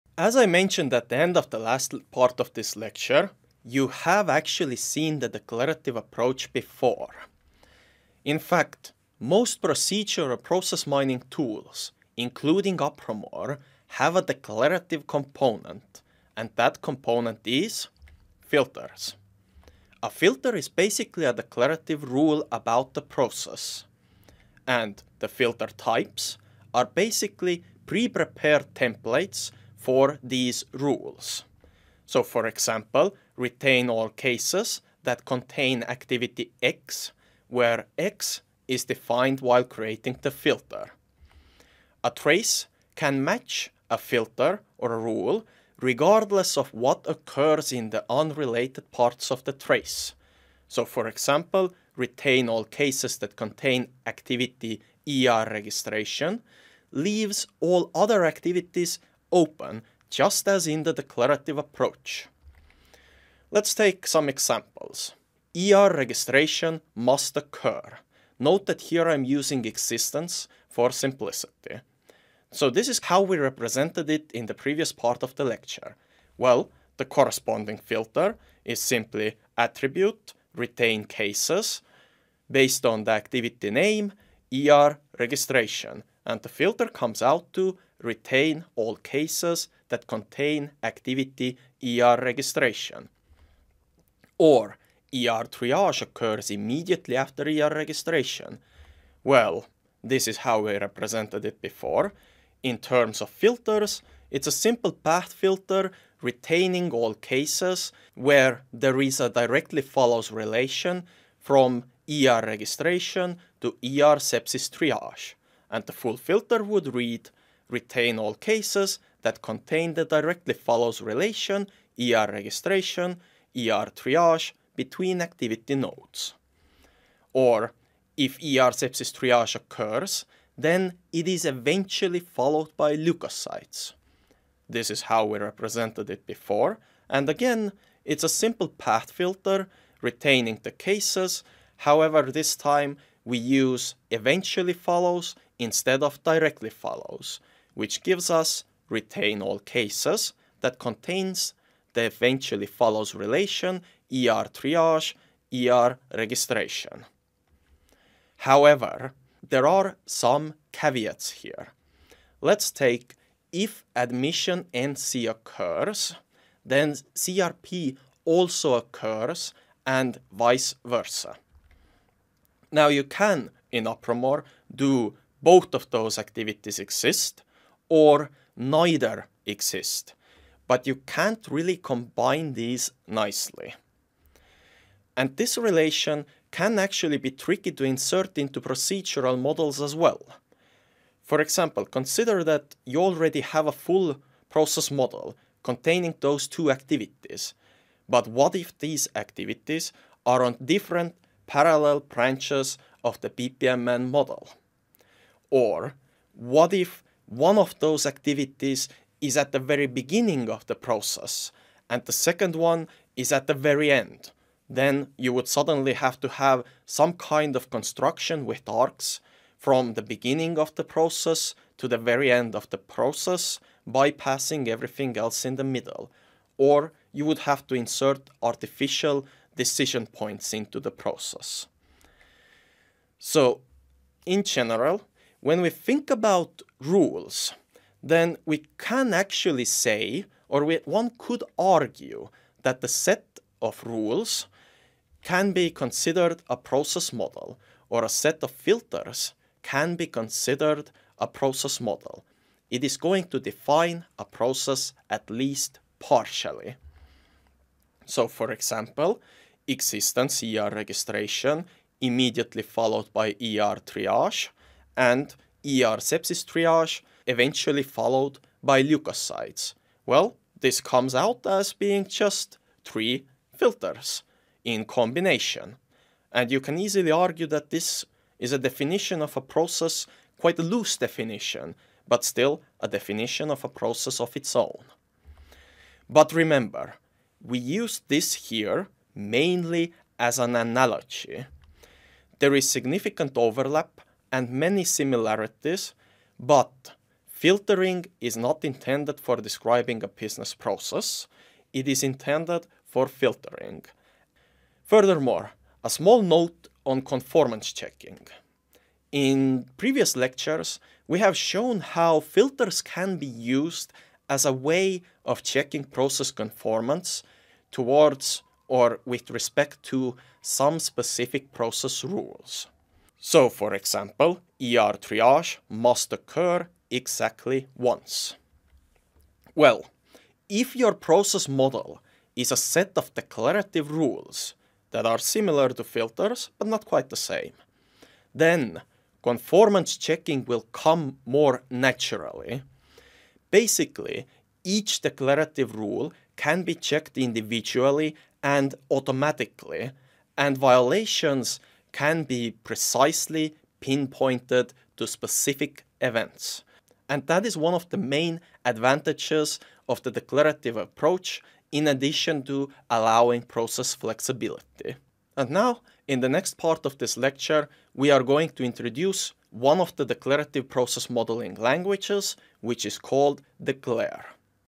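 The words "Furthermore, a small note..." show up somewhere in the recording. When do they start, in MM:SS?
05:04.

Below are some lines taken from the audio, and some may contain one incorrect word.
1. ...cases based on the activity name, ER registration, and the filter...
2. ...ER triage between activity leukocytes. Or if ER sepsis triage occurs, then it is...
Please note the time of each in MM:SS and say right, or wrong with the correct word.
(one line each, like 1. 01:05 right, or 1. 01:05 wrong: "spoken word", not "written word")
1. 01:21 right
2. 02:03 wrong: "nodes", not "leukocytes".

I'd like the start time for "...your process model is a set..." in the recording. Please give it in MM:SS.
05:30.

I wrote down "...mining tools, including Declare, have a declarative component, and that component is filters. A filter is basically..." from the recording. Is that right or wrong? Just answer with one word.
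wrong.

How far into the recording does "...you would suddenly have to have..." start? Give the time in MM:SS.
03:35.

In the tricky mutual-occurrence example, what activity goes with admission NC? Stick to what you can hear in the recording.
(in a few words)
CRP.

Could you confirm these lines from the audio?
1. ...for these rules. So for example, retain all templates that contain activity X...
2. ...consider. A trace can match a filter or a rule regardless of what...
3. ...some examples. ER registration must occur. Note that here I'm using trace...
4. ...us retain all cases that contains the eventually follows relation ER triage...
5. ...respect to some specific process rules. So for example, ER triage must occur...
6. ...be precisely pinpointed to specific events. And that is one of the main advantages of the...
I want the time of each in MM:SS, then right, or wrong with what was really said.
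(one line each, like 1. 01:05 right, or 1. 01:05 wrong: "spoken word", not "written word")
1. 00:29 wrong: "cases", not "templates"
2. 00:40 wrong: "filter", not "consider"
3. 01:04 wrong: "existence", not "trace"
4. 02:28 right
5. 05:19 right
6. 05:52 right.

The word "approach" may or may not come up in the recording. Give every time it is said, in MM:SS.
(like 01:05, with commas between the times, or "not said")
00:05, 01:01, 06:00.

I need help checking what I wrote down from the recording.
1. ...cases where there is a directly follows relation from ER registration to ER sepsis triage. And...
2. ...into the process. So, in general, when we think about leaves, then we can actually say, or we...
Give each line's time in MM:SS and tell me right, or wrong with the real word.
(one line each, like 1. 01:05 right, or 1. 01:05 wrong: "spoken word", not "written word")
1. 01:47 right
2. 03:50 wrong: "rules", not "leaves".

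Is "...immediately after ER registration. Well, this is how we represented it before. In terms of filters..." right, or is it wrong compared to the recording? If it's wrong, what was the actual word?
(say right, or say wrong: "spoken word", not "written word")
right.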